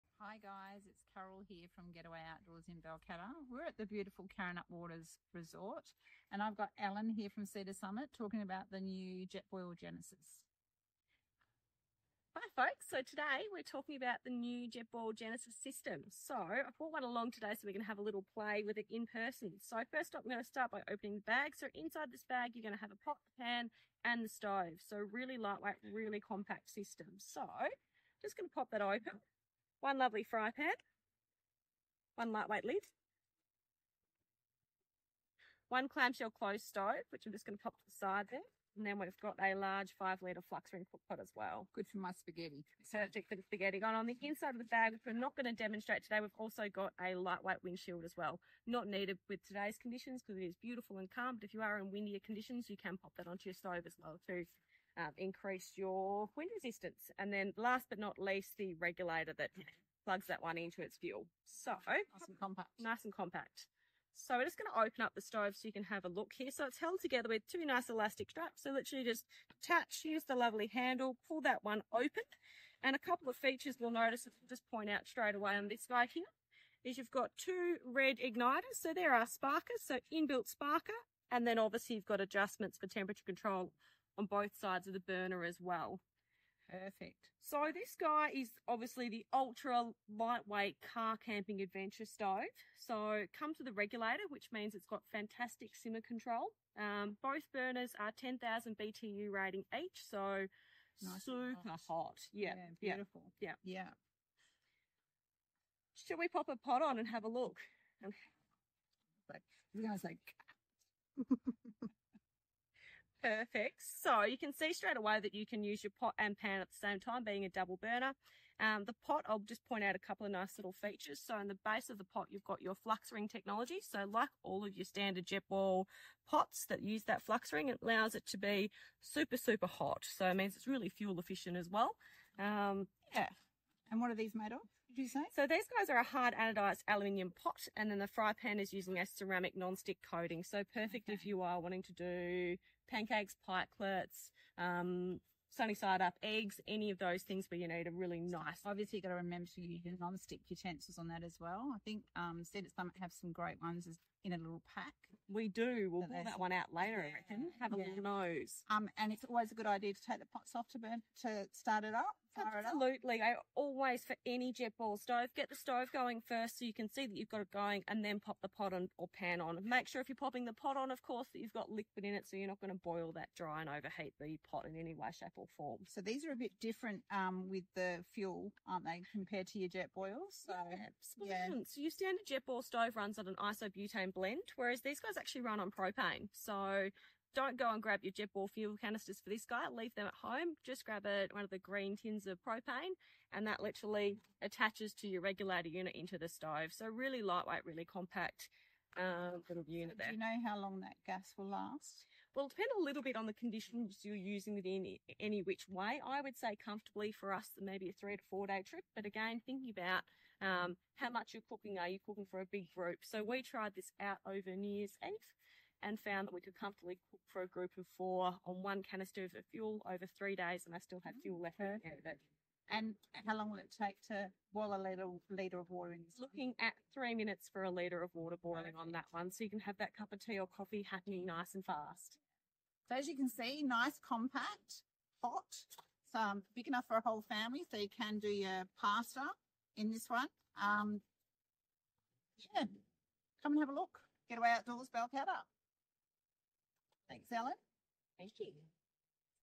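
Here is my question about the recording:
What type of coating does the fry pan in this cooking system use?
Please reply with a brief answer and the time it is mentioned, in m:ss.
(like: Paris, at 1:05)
ceramic non-stick, at 2:19.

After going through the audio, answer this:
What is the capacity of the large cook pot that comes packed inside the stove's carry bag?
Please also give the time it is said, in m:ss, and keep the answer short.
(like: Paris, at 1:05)
5 litre, at 0:39.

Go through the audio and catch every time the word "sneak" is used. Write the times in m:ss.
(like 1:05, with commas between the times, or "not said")
not said.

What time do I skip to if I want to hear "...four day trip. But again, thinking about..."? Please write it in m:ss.
3:28.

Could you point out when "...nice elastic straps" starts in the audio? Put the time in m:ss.
1:07.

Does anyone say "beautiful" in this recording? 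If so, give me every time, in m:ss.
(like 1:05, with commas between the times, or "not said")
0:03, 0:50, 1:42.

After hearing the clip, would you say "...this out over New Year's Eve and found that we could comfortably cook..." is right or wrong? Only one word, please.
right.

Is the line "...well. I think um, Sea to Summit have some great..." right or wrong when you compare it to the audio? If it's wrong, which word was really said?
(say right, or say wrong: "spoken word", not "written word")
right.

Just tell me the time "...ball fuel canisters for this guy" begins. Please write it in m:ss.
3:08.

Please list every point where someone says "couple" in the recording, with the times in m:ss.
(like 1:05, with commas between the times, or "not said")
1:12, 1:59.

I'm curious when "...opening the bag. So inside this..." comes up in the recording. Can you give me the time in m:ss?
0:20.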